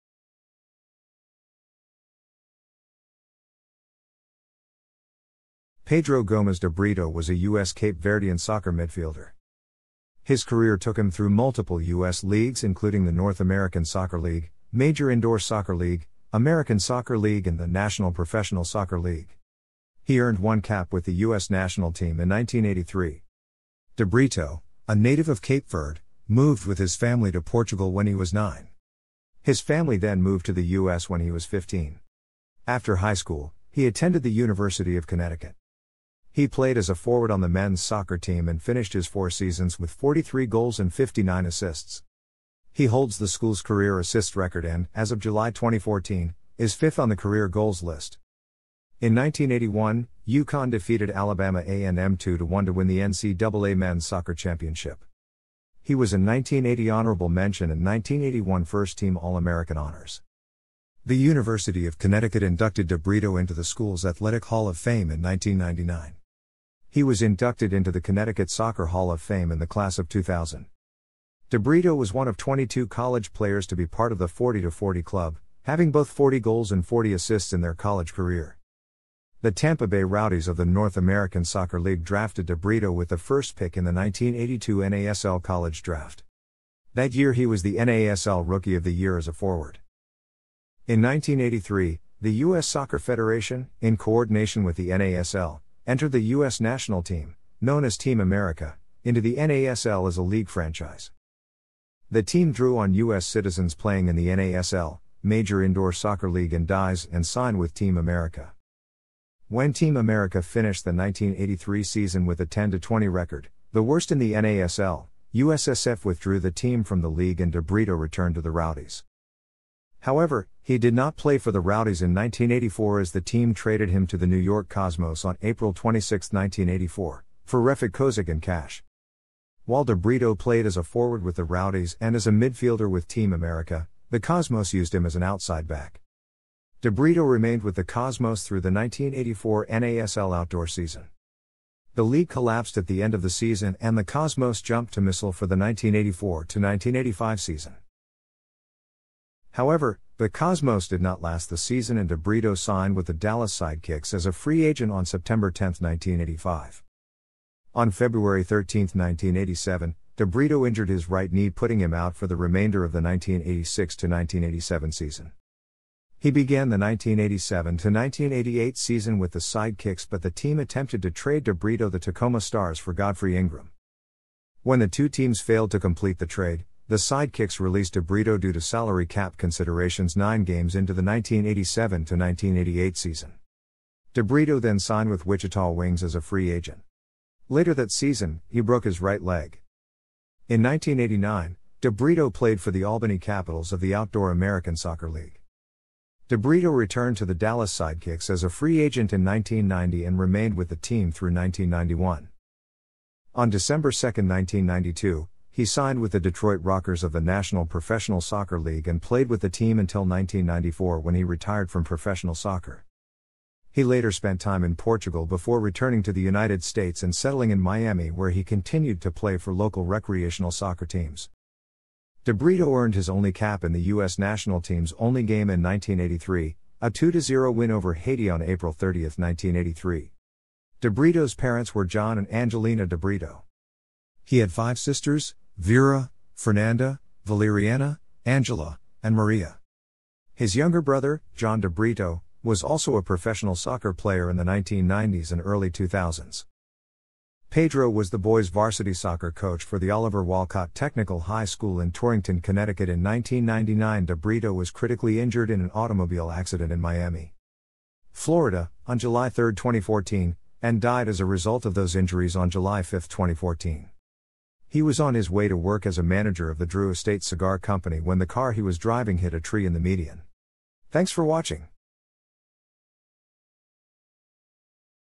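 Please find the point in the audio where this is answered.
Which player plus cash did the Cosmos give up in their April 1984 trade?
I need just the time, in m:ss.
2:07.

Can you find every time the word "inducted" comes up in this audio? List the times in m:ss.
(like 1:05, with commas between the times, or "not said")
1:02, 1:07.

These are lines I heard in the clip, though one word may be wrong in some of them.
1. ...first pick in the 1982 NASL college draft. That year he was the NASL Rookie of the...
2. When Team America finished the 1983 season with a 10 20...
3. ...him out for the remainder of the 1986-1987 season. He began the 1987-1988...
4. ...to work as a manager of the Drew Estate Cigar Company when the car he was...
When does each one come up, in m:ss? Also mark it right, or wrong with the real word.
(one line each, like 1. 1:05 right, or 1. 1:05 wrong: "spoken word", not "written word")
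1. 1:23 right
2. 1:49 right
3. 2:41 right
4. 4:25 right.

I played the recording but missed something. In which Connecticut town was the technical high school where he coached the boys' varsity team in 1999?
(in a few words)
Torrington.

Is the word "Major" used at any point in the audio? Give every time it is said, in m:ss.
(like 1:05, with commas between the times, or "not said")
0:14, 1:45.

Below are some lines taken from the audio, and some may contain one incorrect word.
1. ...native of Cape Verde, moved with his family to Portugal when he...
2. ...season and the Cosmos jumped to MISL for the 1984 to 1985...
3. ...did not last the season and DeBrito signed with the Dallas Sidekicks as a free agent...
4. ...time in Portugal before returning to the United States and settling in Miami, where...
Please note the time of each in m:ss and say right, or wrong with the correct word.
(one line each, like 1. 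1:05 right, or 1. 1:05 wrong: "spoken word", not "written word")
1. 0:24 right
2. 2:23 right
3. 2:30 right
4. 3:34 right.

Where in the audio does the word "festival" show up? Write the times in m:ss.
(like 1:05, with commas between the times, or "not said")
not said.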